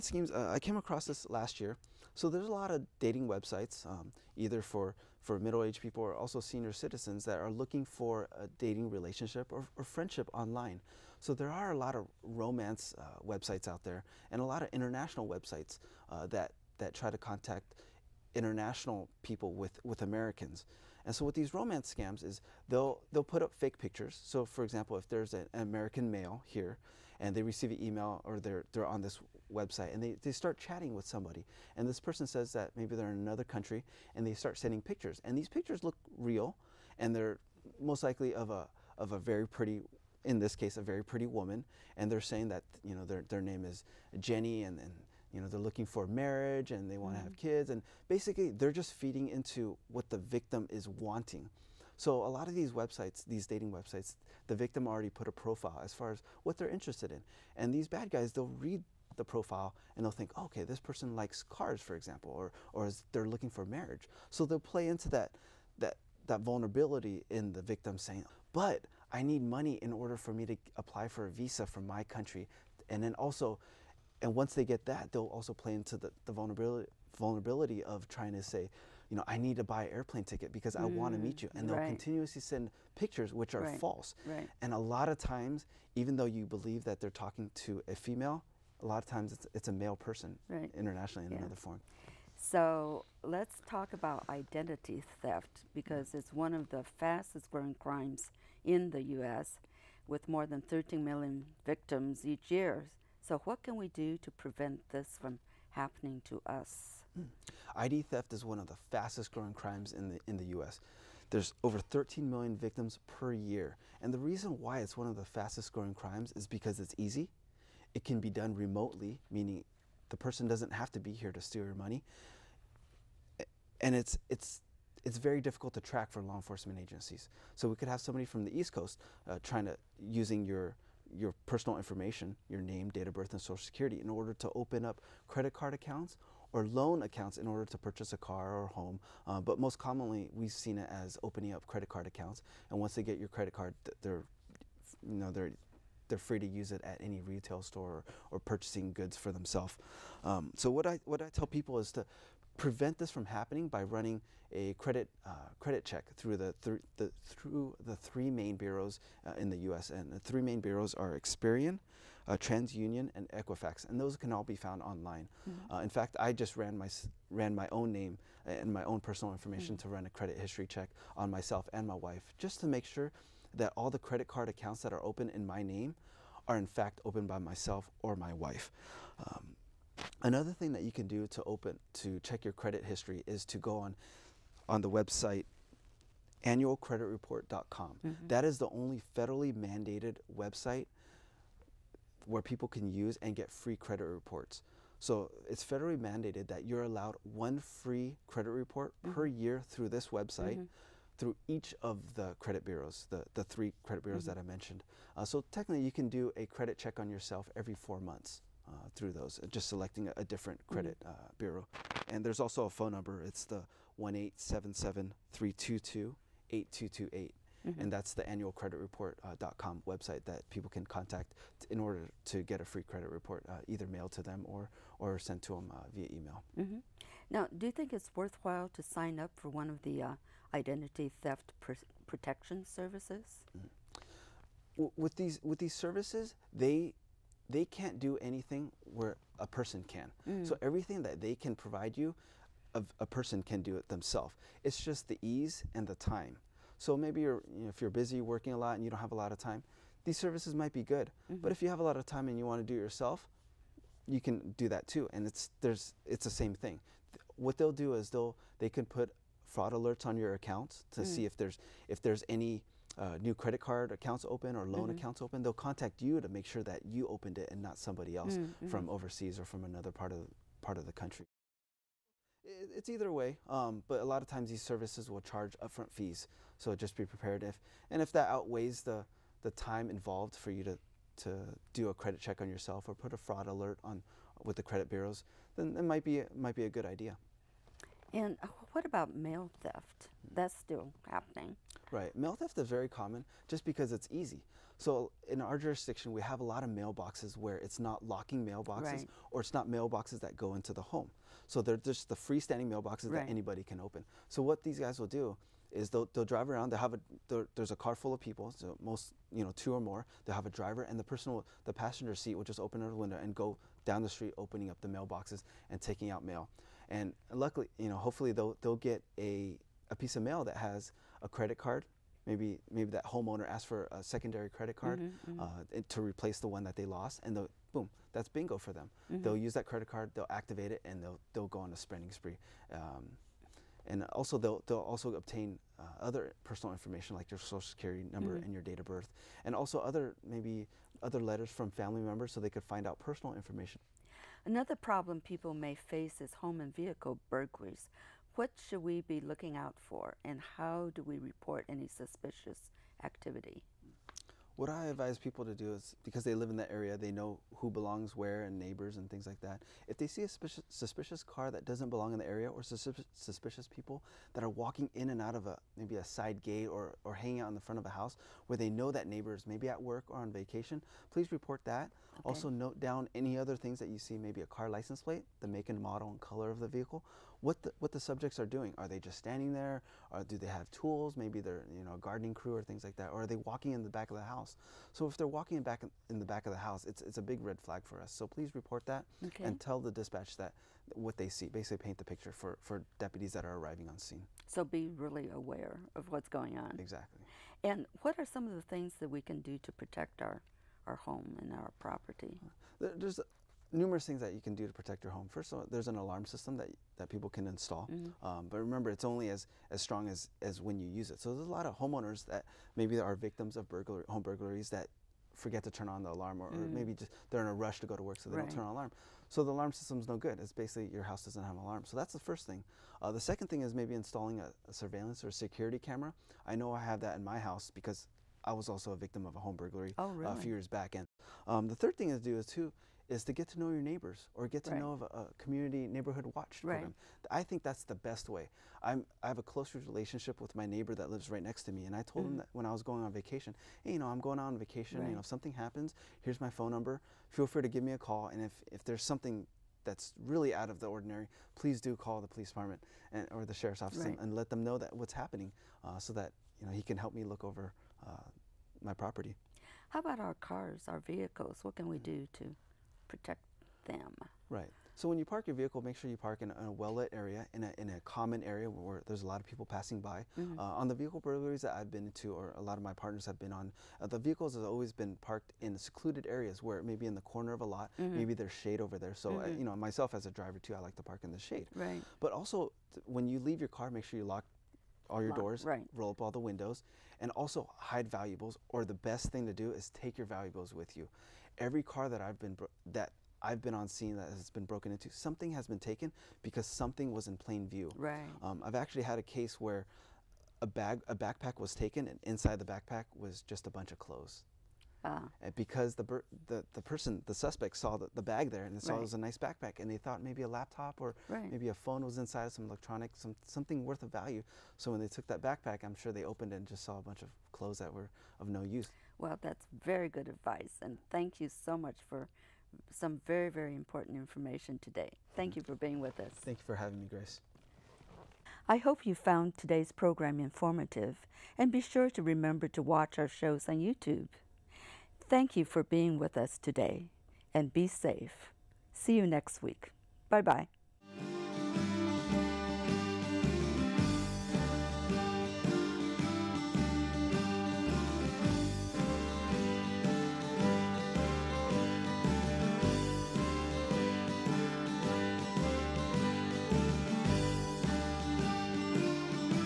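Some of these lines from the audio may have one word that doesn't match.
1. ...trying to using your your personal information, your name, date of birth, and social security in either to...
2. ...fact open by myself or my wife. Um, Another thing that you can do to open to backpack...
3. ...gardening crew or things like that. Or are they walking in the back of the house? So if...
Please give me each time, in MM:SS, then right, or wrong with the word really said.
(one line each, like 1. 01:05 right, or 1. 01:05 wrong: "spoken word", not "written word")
1. 02:09 wrong: "order", not "either"
2. 02:56 wrong: "check", not "backpack"
3. 06:21 right.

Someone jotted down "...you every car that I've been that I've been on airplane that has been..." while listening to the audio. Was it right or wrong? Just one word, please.
wrong.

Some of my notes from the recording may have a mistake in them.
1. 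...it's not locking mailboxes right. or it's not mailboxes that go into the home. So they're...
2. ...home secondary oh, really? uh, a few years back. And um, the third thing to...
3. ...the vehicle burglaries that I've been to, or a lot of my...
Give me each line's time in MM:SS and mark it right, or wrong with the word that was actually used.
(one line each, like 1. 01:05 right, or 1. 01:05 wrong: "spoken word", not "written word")
1. 04:57 right
2. 07:09 wrong: "burglary", not "secondary"
3. 07:50 right.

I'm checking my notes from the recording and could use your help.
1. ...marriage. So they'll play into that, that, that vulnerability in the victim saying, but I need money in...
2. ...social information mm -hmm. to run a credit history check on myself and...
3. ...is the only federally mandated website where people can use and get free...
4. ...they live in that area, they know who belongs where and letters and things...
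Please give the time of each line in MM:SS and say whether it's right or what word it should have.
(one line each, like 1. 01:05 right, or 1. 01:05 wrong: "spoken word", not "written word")
1. 01:03 right
2. 02:48 wrong: "personal", not "social"
3. 03:08 right
4. 05:56 wrong: "neighbors", not "letters".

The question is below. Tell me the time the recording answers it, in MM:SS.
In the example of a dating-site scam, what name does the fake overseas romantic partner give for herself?
00:44.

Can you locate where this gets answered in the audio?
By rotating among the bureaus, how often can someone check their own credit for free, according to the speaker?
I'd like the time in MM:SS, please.
03:27.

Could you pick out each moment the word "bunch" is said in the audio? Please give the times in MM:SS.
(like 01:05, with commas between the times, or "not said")
08:23, 08:37.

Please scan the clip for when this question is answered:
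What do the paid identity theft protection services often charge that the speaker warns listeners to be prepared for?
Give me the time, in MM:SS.
04:35.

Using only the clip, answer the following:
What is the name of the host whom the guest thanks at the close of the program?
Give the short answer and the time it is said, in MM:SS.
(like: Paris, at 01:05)
Grace, at 08:47.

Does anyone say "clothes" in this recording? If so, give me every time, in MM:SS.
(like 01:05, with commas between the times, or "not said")
08:23, 08:37.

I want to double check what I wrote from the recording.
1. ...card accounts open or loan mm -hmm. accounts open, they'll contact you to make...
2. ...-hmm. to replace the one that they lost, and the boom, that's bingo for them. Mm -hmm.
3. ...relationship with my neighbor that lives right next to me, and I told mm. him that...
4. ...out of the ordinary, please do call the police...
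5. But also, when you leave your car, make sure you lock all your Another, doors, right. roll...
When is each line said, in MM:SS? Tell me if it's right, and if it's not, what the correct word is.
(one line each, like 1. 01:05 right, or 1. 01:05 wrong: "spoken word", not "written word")
1. 04:23 right
2. 05:25 right
3. 07:19 right
4. 07:30 right
5. 08:02 wrong: "Lock", not "Another".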